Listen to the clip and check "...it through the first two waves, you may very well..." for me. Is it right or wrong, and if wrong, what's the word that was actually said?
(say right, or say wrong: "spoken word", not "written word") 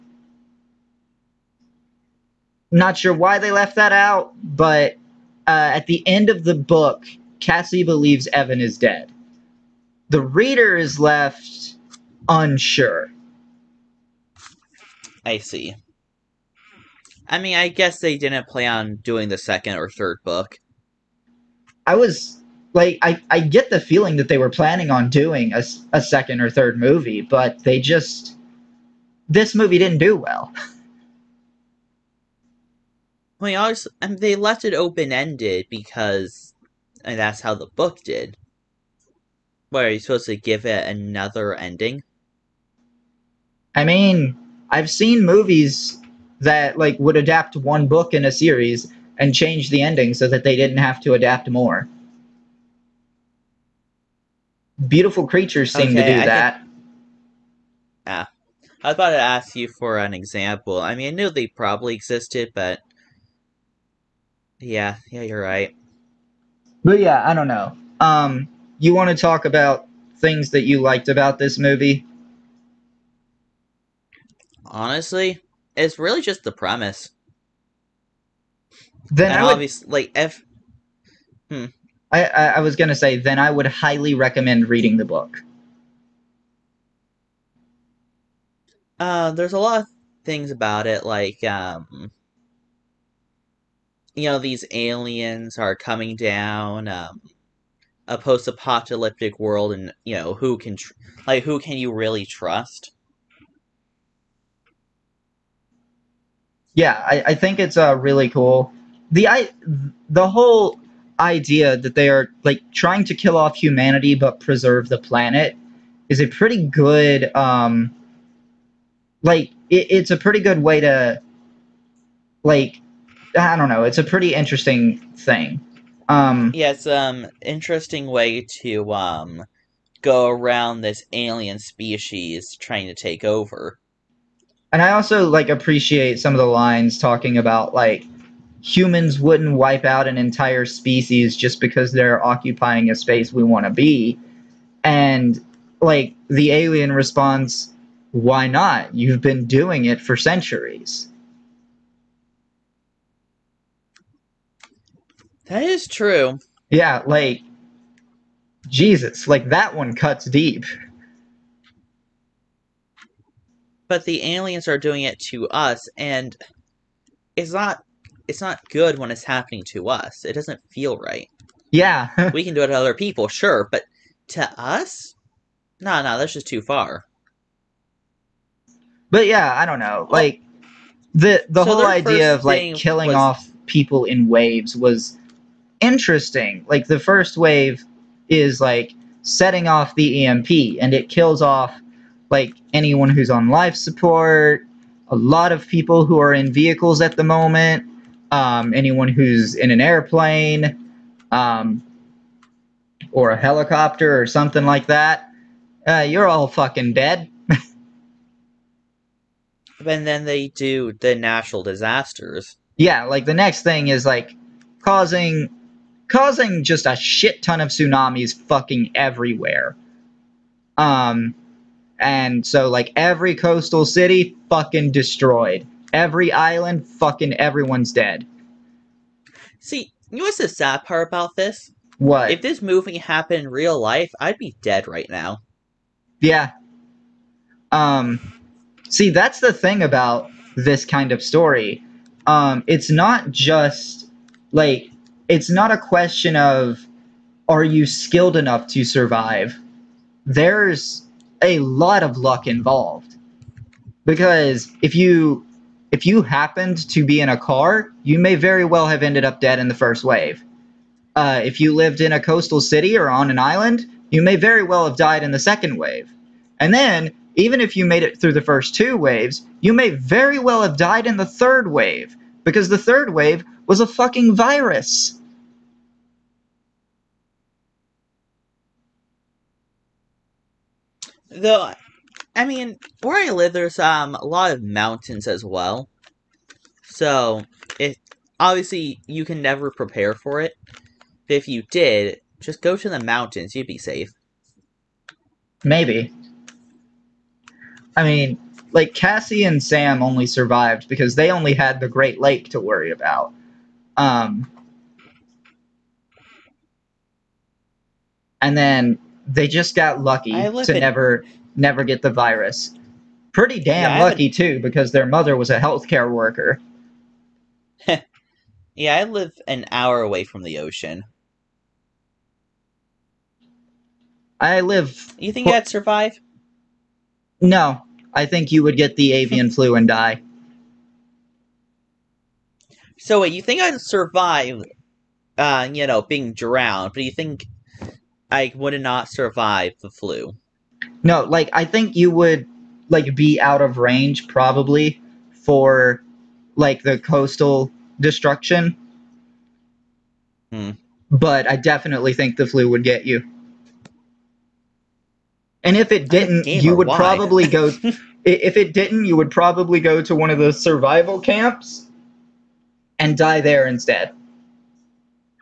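right.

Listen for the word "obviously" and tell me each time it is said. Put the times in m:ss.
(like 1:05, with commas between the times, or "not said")
1:19, 4:48.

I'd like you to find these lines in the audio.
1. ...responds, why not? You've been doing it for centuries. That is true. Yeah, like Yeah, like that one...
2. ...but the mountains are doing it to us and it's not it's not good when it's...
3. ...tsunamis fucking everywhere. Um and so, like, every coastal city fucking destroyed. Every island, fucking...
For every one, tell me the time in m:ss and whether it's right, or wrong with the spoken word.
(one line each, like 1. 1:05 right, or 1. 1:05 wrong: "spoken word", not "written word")
1. 2:26 wrong: "Jesus", not "Yeah"
2. 2:43 wrong: "aliens", not "mountains"
3. 3:37 right.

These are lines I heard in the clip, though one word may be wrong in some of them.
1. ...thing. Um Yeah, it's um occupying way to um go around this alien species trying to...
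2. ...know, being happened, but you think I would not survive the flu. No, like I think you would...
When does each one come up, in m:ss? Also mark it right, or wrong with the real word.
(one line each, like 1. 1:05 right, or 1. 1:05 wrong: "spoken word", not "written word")
1. 2:05 wrong: "interesting", not "occupying"
2. 5:35 wrong: "drowned", not "happened".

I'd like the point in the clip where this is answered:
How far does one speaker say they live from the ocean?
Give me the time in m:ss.
5:19.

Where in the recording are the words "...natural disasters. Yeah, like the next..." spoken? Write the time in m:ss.
3:31.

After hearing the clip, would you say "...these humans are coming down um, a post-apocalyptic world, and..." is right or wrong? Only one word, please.
wrong.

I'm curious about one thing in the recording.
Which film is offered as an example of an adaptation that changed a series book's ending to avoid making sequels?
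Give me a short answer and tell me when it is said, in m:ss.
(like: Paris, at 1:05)
Beautiful Creatures, at 0:54.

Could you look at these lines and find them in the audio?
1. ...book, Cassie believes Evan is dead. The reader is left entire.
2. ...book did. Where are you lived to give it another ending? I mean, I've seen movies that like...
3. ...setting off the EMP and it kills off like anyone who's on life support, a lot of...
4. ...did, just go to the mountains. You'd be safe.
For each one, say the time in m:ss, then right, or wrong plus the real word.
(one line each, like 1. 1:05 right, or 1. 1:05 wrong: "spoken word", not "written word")
1. 0:06 wrong: "unsure", not "entire"
2. 0:37 wrong: "supposed", not "lived"
3. 3:09 right
4. 4:51 right.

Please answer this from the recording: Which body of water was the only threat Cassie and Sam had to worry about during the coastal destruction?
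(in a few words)
the Great Lake.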